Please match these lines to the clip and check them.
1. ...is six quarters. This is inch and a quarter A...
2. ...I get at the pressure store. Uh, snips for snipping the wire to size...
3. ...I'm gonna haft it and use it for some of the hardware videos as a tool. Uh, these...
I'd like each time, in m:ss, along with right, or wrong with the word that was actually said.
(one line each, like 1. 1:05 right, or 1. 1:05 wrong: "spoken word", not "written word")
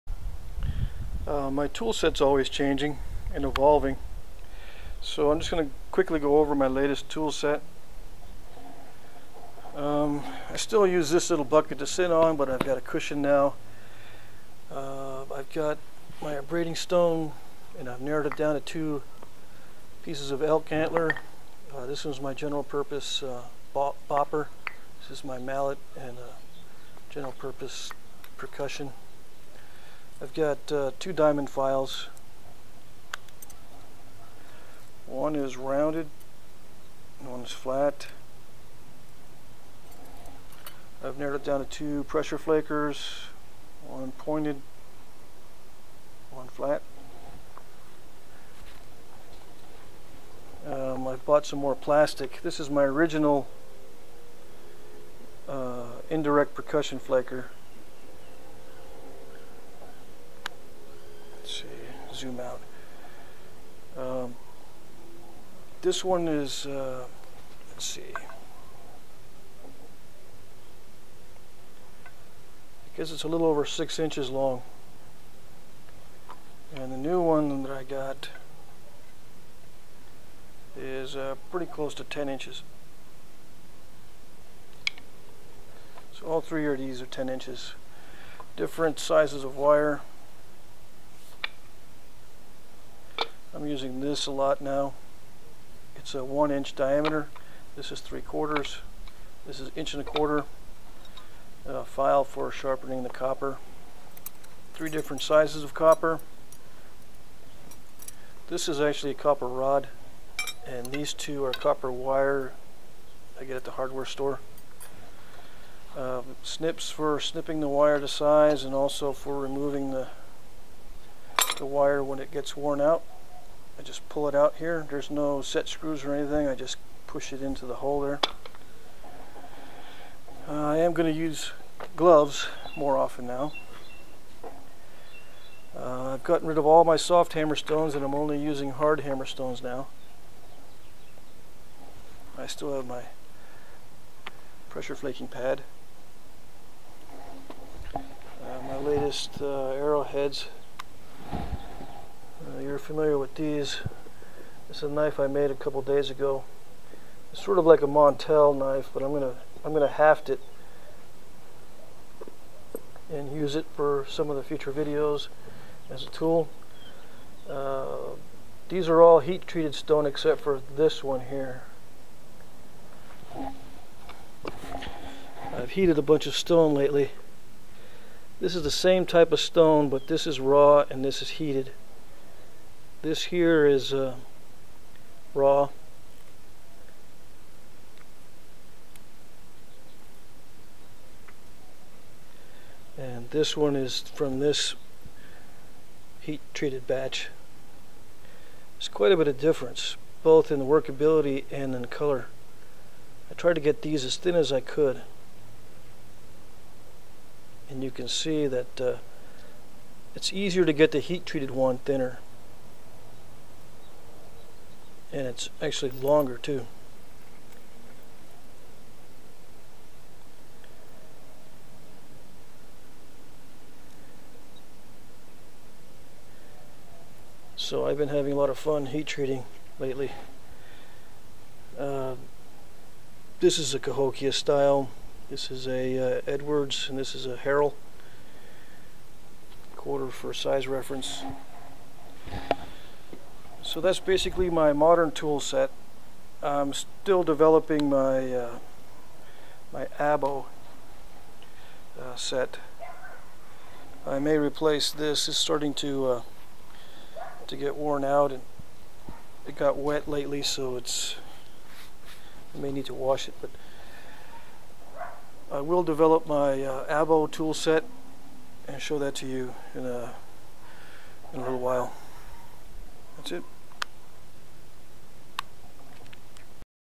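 1. 1:37 wrong: "three", not "six"
2. 1:53 wrong: "hardware", not "pressure"
3. 2:39 wrong: "future", not "hardware".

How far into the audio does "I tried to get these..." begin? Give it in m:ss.
3:23.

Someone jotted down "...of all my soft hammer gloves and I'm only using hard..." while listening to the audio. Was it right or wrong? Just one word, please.
wrong.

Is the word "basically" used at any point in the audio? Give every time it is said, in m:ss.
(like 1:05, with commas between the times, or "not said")
4:04.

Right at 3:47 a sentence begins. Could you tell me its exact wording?
So I've been having a lot of fun heat treating lately.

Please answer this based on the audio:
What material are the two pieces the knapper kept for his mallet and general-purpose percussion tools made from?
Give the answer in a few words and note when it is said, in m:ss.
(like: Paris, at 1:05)
Elk antler, at 0:20.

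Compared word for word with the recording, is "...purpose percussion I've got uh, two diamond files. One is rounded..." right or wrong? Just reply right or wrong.
right.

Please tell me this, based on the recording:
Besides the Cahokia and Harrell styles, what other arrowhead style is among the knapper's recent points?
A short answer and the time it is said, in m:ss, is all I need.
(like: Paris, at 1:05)
Edwards, at 3:56.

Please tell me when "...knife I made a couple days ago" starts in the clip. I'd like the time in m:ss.
2:34.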